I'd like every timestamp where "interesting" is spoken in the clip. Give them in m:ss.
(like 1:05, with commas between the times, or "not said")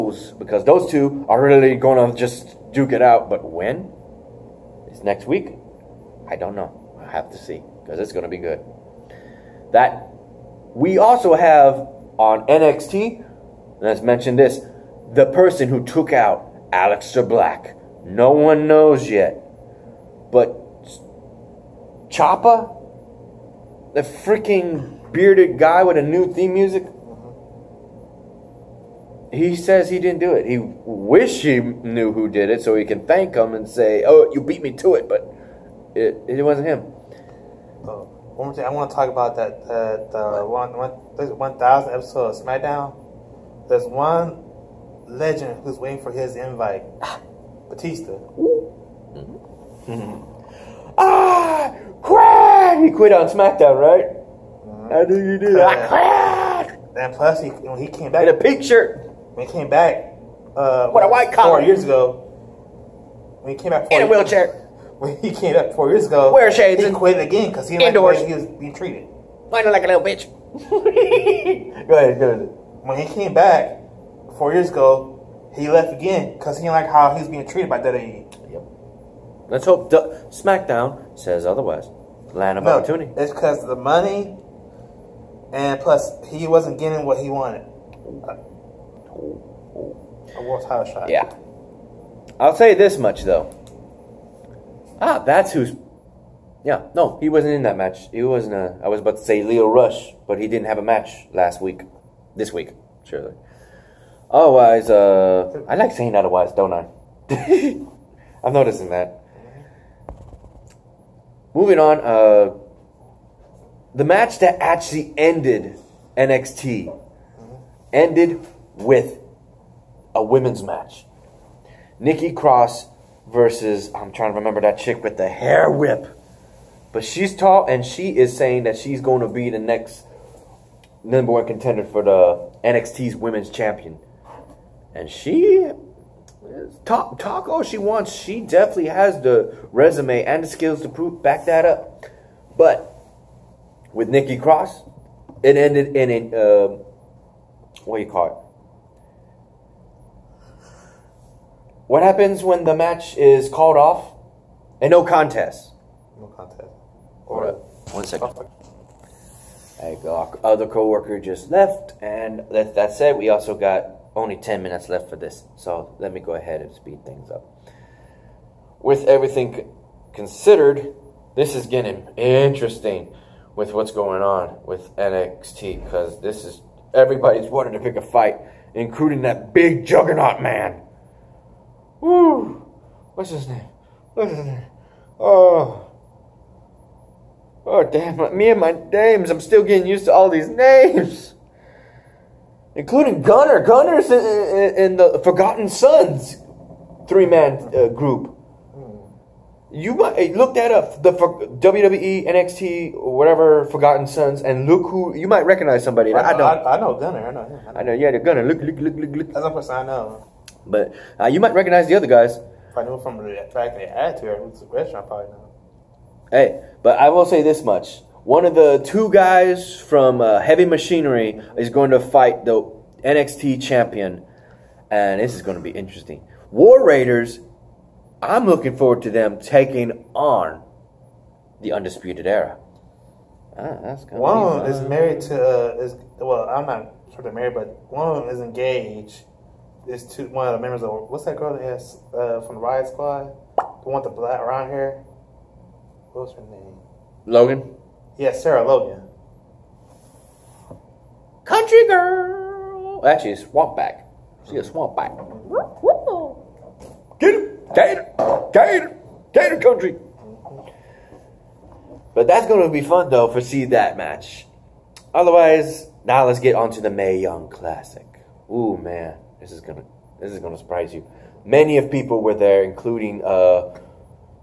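2:52, 3:45.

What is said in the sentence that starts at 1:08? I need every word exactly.
like the way he was being treated.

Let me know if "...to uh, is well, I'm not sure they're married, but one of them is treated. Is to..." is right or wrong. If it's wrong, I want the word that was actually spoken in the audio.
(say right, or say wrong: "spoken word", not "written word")
wrong: "engaged", not "treated".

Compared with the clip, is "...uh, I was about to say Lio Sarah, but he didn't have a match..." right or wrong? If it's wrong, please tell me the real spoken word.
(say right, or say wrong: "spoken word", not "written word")
wrong: "Rush", not "Sarah".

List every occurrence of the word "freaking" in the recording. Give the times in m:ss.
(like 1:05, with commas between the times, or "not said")
0:24.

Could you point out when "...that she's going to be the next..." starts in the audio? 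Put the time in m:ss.
2:08.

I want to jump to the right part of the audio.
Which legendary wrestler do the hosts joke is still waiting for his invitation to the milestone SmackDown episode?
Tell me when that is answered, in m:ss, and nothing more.
0:47.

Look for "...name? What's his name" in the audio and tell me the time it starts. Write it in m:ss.
3:03.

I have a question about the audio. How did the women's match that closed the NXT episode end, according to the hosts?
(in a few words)
No contest.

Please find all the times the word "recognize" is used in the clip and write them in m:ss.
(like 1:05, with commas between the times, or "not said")
3:25, 3:31.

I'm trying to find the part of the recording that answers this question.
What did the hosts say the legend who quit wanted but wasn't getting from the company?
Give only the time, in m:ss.
1:30.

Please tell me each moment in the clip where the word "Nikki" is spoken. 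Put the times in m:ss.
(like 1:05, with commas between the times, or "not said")
2:01, 2:24.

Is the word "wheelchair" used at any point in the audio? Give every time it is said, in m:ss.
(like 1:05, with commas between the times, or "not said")
1:04.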